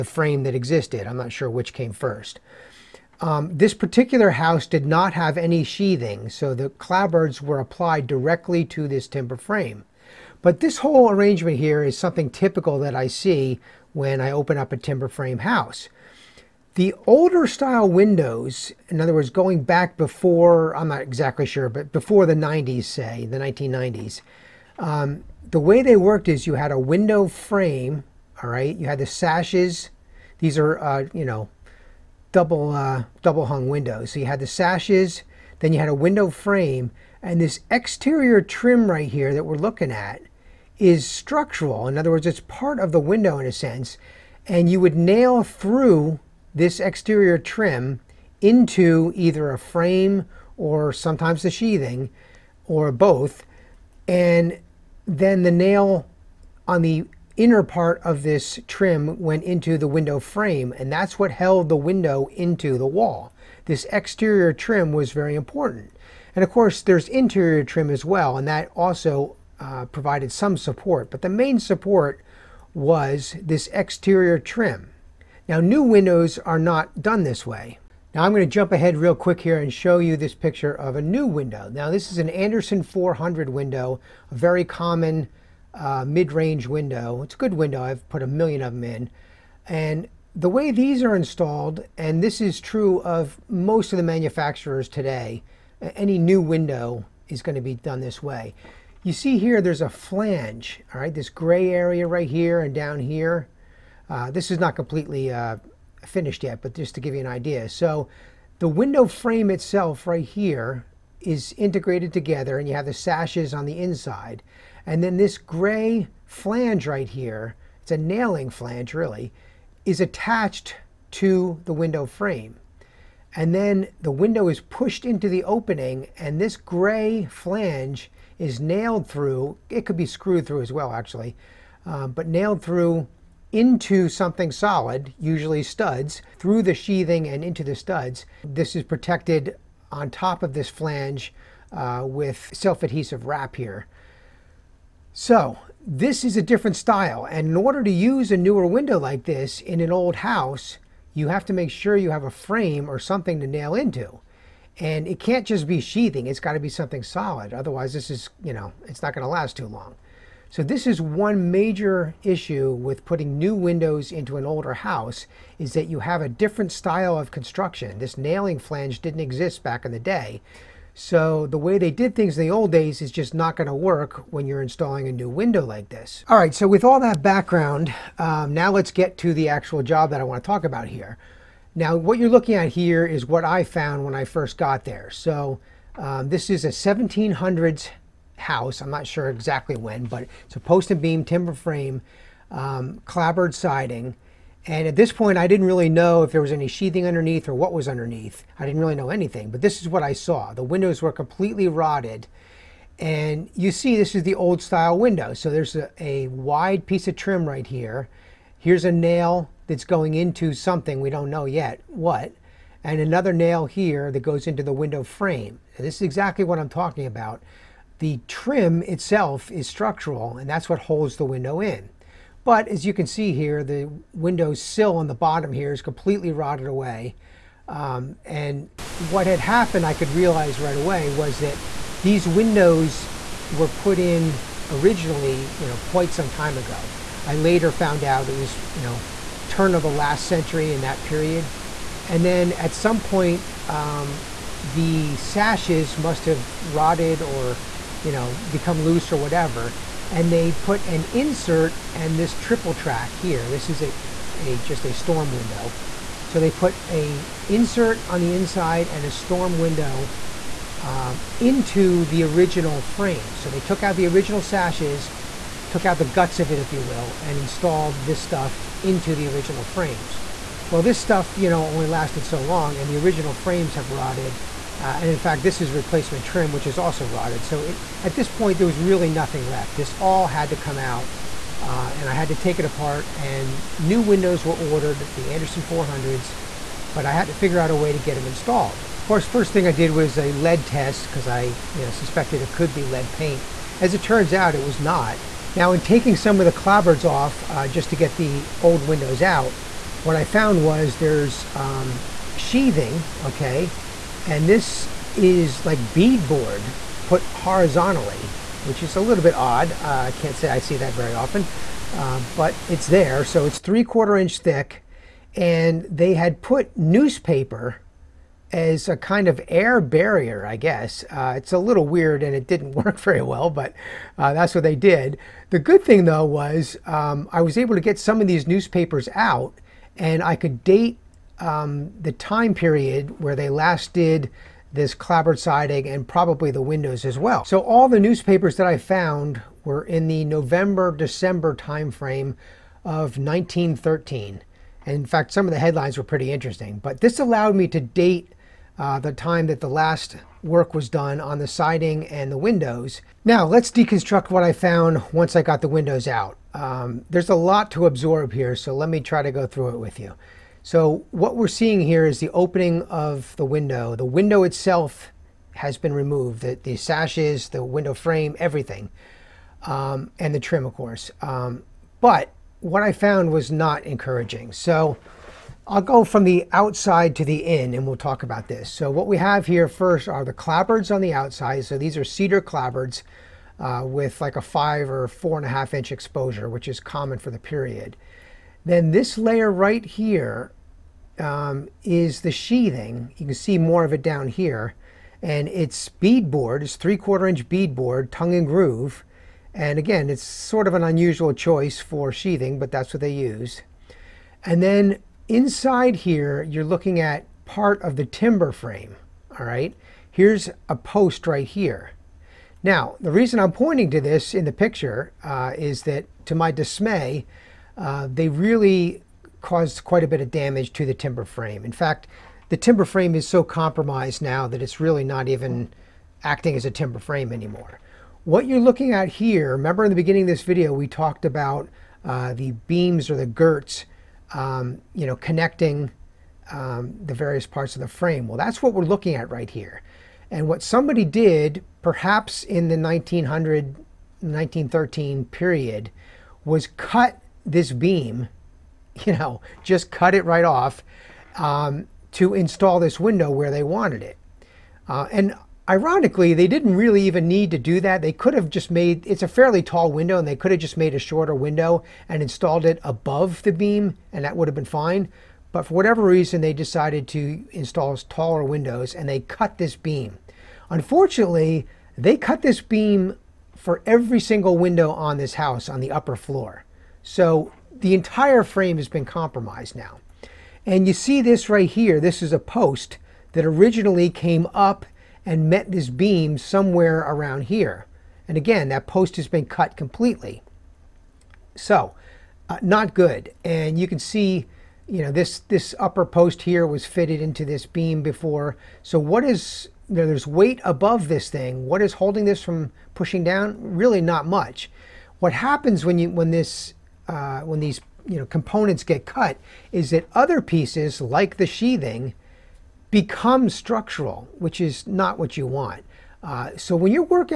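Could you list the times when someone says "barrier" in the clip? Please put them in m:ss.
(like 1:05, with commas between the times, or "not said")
5:19.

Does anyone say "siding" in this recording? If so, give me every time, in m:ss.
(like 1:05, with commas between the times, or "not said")
3:13, 5:35, 5:51.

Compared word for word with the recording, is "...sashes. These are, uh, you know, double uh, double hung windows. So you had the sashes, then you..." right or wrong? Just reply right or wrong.
right.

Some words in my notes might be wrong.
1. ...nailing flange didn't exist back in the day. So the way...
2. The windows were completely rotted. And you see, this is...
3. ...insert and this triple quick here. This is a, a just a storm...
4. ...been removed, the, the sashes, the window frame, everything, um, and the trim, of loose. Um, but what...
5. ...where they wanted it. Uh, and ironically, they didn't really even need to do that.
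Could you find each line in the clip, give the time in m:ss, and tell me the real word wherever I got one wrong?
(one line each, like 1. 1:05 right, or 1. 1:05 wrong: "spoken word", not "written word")
1. 2:48 right
2. 3:20 right
3. 4:11 wrong: "track", not "quick"
4. 6:05 wrong: "course", not "loose"
5. 7:33 right.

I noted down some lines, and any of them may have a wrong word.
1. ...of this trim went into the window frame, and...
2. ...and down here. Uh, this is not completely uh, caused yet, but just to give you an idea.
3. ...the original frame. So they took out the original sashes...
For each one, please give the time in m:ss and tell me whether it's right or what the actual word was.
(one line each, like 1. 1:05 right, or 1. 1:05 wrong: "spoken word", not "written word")
1. 0:58 right
2. 1:42 wrong: "finished", not "caused"
3. 4:22 right.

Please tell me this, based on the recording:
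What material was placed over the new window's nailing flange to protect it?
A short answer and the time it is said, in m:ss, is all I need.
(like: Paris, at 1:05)
self-adhesive wrap, at 2:22.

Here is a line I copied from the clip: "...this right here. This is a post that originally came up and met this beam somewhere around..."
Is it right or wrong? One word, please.
right.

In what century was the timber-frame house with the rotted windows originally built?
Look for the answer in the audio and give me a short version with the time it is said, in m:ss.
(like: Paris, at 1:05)
1700s, at 3:06.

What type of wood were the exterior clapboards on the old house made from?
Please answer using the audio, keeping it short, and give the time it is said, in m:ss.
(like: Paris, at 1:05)
cedar, at 6:22.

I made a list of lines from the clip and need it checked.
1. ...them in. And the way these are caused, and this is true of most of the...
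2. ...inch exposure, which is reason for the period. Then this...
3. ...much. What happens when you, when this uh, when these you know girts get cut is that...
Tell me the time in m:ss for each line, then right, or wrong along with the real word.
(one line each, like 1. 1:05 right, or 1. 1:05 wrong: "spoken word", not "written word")
1. 1:28 wrong: "installed", not "caused"
2. 6:25 wrong: "common", not "reason"
3. 8:24 wrong: "components", not "girts".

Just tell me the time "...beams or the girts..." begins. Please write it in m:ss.
7:12.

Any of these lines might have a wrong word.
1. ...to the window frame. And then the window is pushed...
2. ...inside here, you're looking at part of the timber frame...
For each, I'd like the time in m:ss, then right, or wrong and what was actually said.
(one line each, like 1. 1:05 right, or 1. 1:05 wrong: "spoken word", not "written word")
1. 2:01 right
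2. 6:45 right.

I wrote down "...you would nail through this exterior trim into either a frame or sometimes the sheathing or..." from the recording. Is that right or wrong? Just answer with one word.
right.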